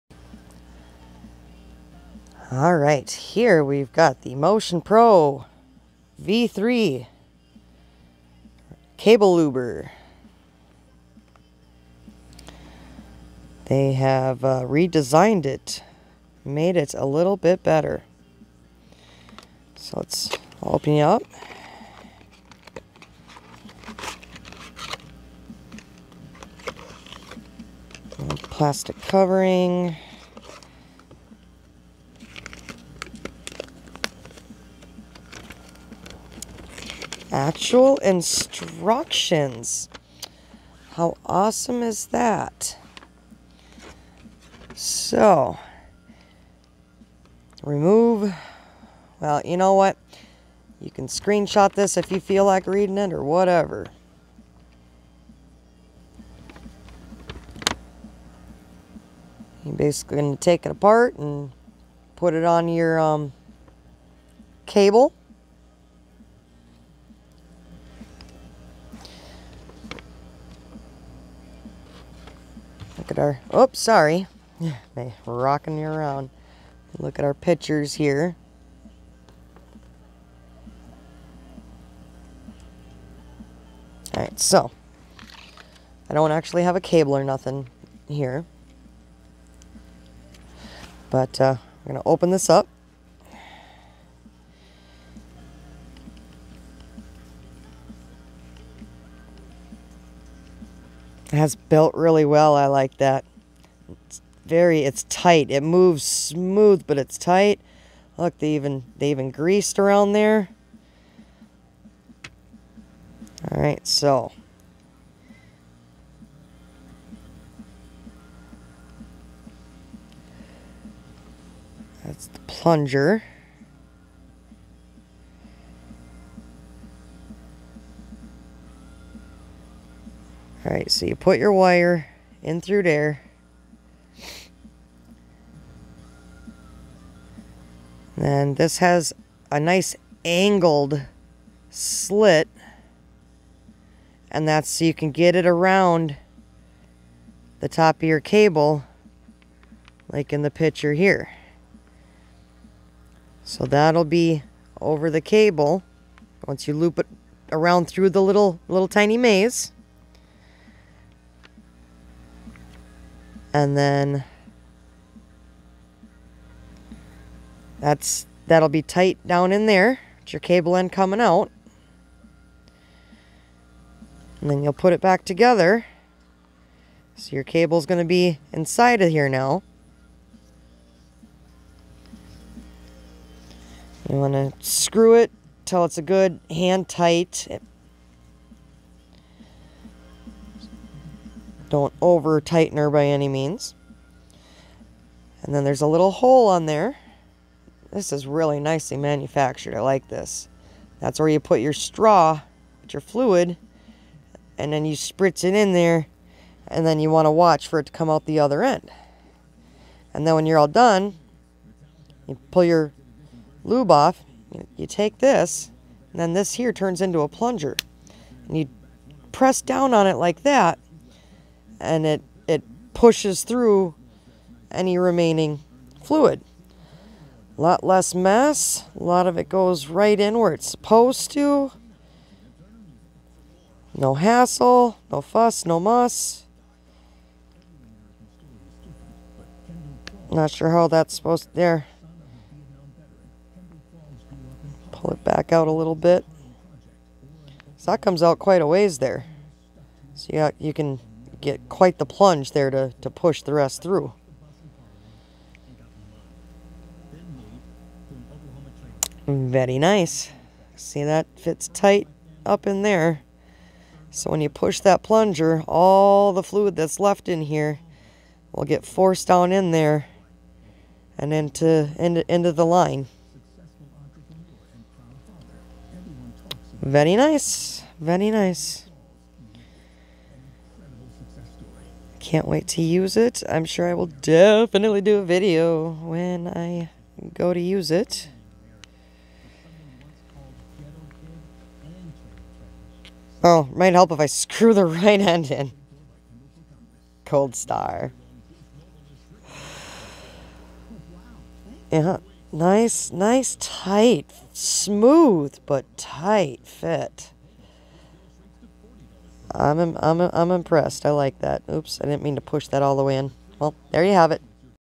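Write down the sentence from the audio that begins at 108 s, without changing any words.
Look, they even, they even greased around there.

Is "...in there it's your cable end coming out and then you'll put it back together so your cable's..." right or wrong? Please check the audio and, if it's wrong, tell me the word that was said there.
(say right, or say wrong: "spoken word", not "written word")
right.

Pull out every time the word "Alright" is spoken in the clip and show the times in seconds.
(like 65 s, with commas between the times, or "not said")
130 s.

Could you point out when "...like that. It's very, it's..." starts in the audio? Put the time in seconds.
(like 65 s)
102 s.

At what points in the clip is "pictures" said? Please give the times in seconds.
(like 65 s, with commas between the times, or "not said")
77 s, 150 s.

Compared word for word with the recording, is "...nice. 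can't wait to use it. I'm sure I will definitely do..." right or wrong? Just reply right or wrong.
right.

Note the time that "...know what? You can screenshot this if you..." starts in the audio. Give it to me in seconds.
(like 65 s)
49 s.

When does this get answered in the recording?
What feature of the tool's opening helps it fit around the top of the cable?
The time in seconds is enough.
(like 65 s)
140 s.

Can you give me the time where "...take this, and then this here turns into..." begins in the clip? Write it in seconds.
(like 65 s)
214 s.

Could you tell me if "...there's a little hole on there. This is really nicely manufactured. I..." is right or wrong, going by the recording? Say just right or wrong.
right.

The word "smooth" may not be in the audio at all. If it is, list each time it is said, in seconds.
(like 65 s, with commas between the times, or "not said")
106 s, 304 s.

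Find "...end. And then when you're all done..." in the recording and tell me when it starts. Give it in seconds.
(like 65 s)
208 s.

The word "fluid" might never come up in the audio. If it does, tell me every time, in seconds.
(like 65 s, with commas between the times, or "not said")
202 s, 226 s, 266 s.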